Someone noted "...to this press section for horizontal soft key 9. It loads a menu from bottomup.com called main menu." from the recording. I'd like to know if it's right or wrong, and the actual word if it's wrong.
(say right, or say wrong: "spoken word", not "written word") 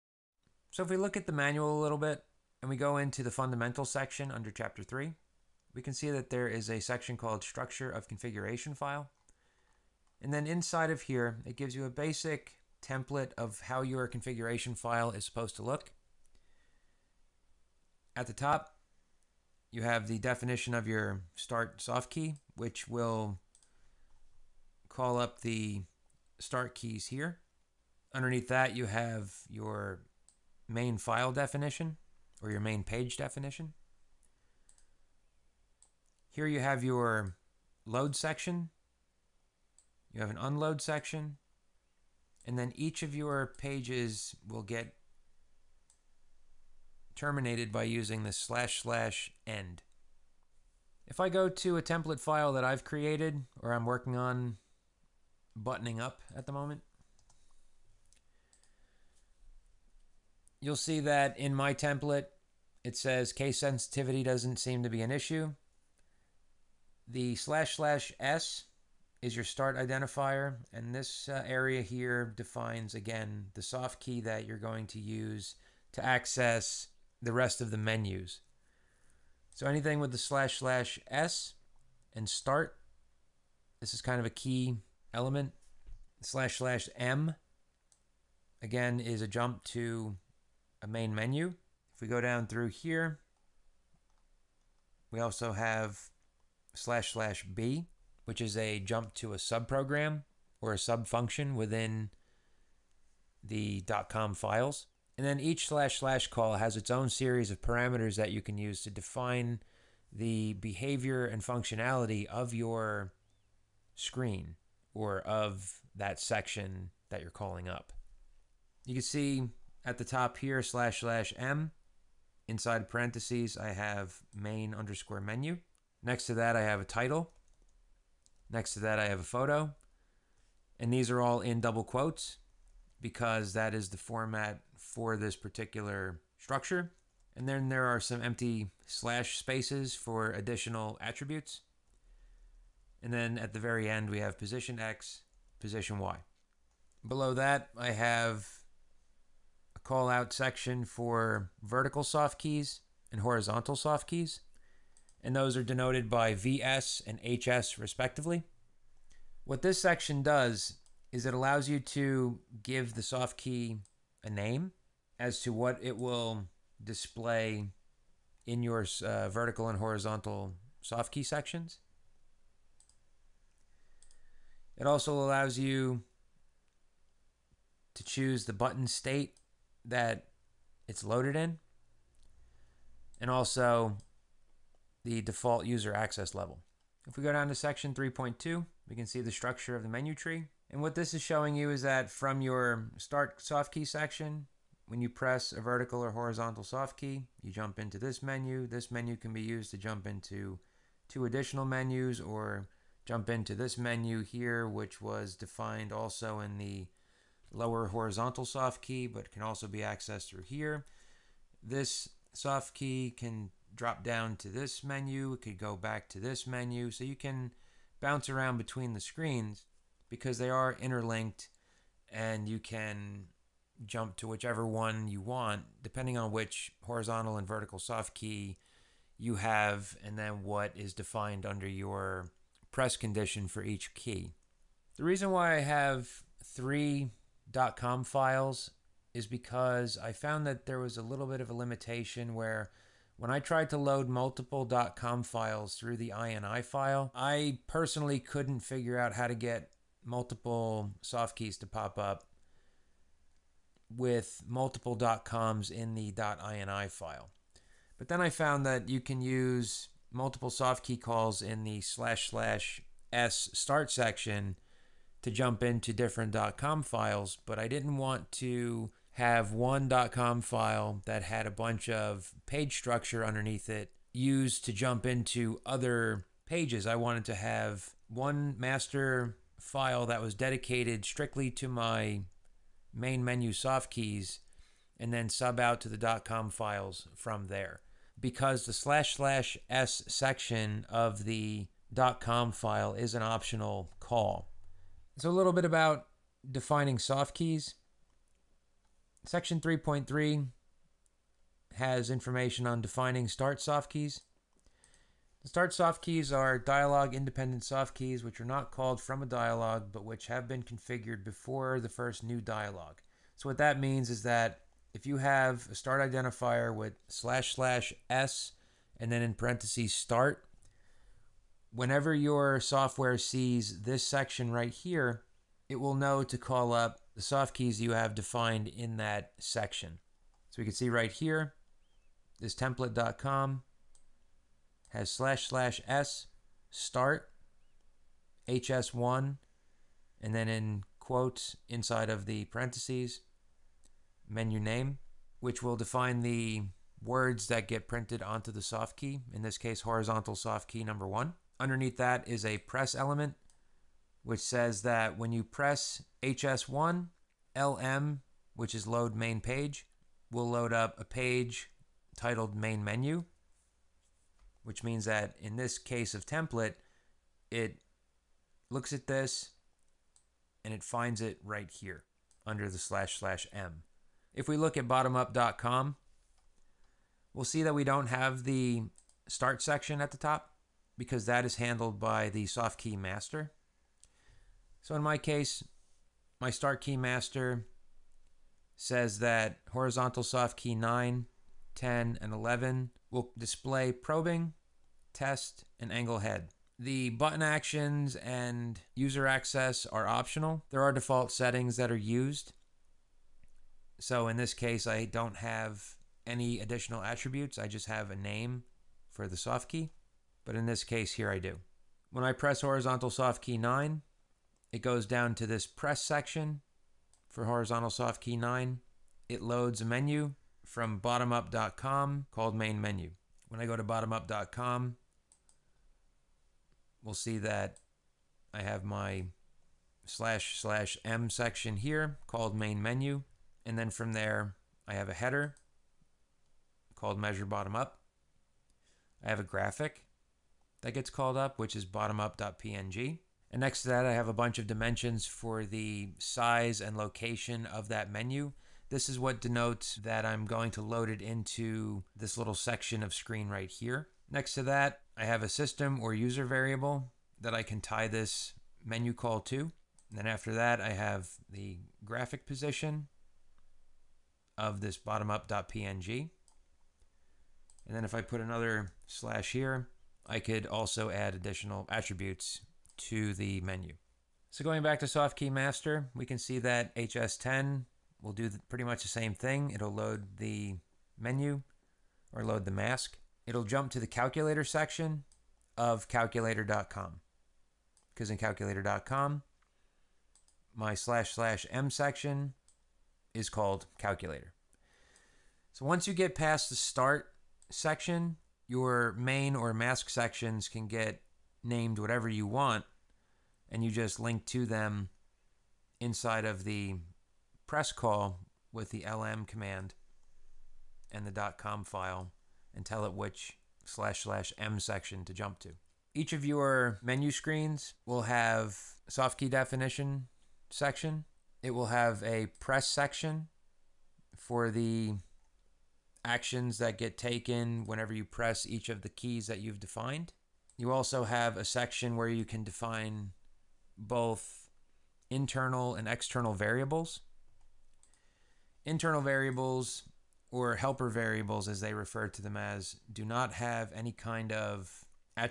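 right.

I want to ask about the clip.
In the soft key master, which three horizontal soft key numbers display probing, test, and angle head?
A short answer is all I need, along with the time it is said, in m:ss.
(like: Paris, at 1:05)
9, 10, and 11, at 6:30.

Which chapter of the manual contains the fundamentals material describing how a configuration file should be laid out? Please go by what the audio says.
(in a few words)
Chapter 3.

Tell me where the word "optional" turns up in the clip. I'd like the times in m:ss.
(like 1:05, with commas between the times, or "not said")
4:53, 6:40.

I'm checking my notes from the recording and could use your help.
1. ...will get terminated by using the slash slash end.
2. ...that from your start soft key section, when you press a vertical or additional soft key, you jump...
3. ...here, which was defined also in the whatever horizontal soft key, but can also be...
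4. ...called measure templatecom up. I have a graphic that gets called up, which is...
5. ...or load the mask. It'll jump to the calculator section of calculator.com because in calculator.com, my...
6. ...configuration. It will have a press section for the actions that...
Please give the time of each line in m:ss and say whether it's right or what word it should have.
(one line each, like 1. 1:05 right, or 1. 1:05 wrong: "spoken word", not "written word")
1. 0:44 right
2. 3:11 wrong: "horizontal", not "additional"
3. 3:24 wrong: "lower", not "whatever"
4. 7:16 wrong: "bottom", not "templatecom"
5. 8:02 right
6. 8:40 wrong: "section", not "configuration".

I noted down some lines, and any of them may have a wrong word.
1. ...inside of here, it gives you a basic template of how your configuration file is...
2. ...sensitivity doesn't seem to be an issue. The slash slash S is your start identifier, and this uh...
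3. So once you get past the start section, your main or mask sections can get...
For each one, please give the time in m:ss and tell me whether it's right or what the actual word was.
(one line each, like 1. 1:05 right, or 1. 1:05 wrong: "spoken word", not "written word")
1. 0:10 right
2. 1:03 right
3. 8:15 right.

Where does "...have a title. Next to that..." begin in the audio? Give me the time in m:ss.
2:06.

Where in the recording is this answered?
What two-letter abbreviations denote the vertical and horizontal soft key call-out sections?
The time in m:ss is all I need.
2:36.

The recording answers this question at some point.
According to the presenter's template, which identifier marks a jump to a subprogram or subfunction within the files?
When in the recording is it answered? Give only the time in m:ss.
1:36.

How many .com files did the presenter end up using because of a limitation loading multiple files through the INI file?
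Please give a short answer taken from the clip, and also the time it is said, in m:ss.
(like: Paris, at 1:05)
3, at 3:56.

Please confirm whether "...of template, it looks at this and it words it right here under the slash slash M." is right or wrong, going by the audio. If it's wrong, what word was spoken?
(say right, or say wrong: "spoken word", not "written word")
wrong: "finds", not "words".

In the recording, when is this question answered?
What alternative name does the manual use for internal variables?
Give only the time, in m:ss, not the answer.
9:00.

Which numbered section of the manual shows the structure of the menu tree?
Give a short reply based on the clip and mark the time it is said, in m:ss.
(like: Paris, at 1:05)
3.2, at 3:07.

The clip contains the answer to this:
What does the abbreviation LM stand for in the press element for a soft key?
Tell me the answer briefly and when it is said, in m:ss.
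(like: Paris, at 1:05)
load main page, at 5:58.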